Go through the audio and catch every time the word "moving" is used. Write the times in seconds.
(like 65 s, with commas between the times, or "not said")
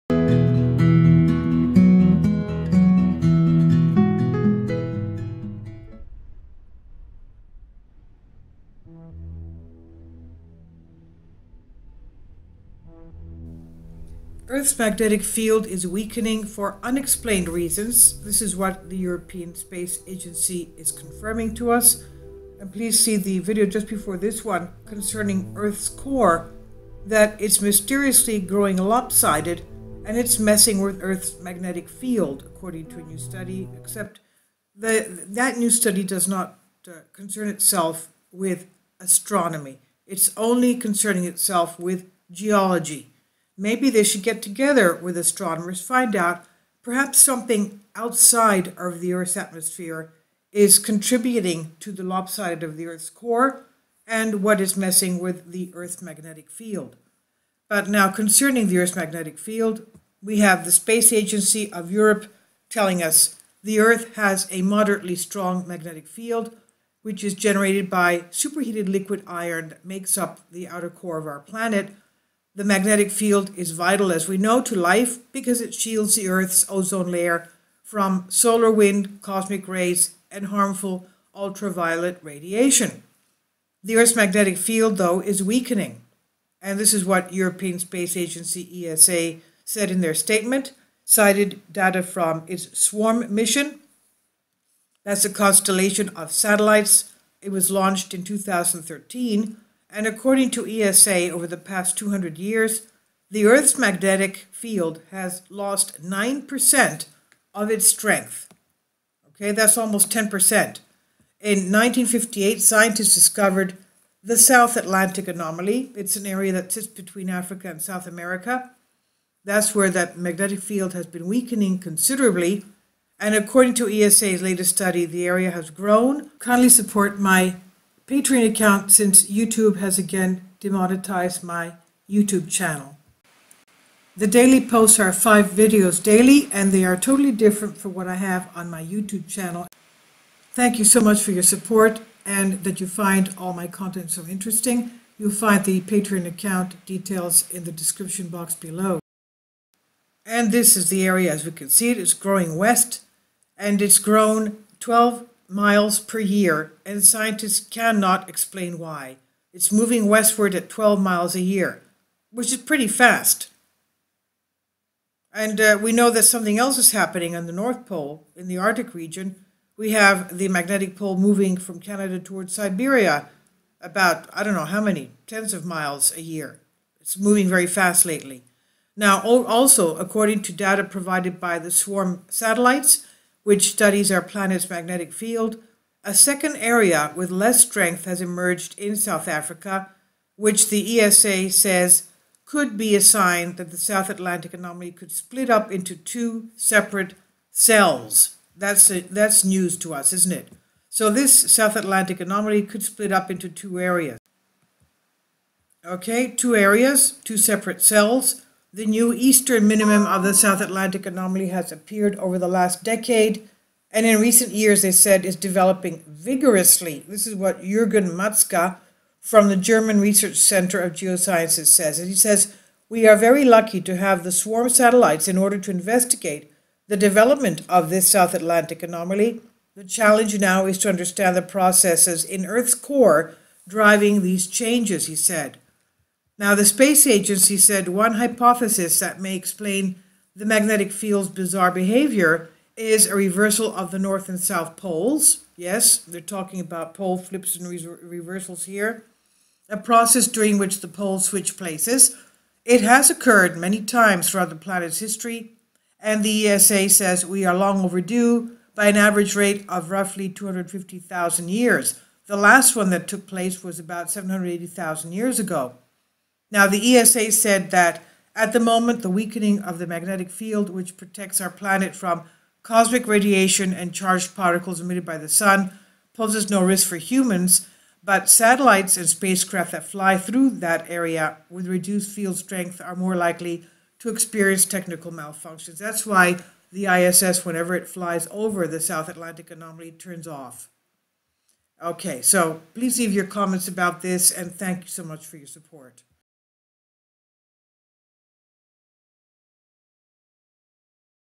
159 s, 171 s, 177 s.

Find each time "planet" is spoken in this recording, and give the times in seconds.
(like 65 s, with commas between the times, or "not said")
71 s, 184 s, 254 s, 271 s.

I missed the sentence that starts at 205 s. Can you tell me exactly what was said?
Okay, two areas, two separate cells.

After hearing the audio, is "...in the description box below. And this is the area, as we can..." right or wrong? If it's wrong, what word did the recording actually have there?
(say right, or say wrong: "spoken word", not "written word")
right.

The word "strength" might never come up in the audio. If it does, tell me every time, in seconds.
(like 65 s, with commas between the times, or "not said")
107 s, 187 s, 282 s.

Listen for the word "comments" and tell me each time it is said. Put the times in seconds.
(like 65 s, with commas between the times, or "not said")
293 s.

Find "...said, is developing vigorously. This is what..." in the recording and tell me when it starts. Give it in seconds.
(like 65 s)
214 s.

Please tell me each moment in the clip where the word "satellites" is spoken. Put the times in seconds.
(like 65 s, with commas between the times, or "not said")
96 s, 182 s, 224 s, 278 s.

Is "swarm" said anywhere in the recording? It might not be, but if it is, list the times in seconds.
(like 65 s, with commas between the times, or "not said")
92 s, 181 s, 224 s.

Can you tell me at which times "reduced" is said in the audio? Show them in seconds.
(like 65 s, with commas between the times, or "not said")
281 s.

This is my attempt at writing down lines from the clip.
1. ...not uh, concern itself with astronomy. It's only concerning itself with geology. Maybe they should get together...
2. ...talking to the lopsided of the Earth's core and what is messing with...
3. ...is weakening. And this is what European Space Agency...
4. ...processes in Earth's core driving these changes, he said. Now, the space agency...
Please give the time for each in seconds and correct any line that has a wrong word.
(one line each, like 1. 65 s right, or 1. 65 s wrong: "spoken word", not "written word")
1. 36 s right
2. 50 s wrong: "contributing", not "talking"
3. 85 s right
4. 231 s right.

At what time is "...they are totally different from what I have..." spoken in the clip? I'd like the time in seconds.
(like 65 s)
136 s.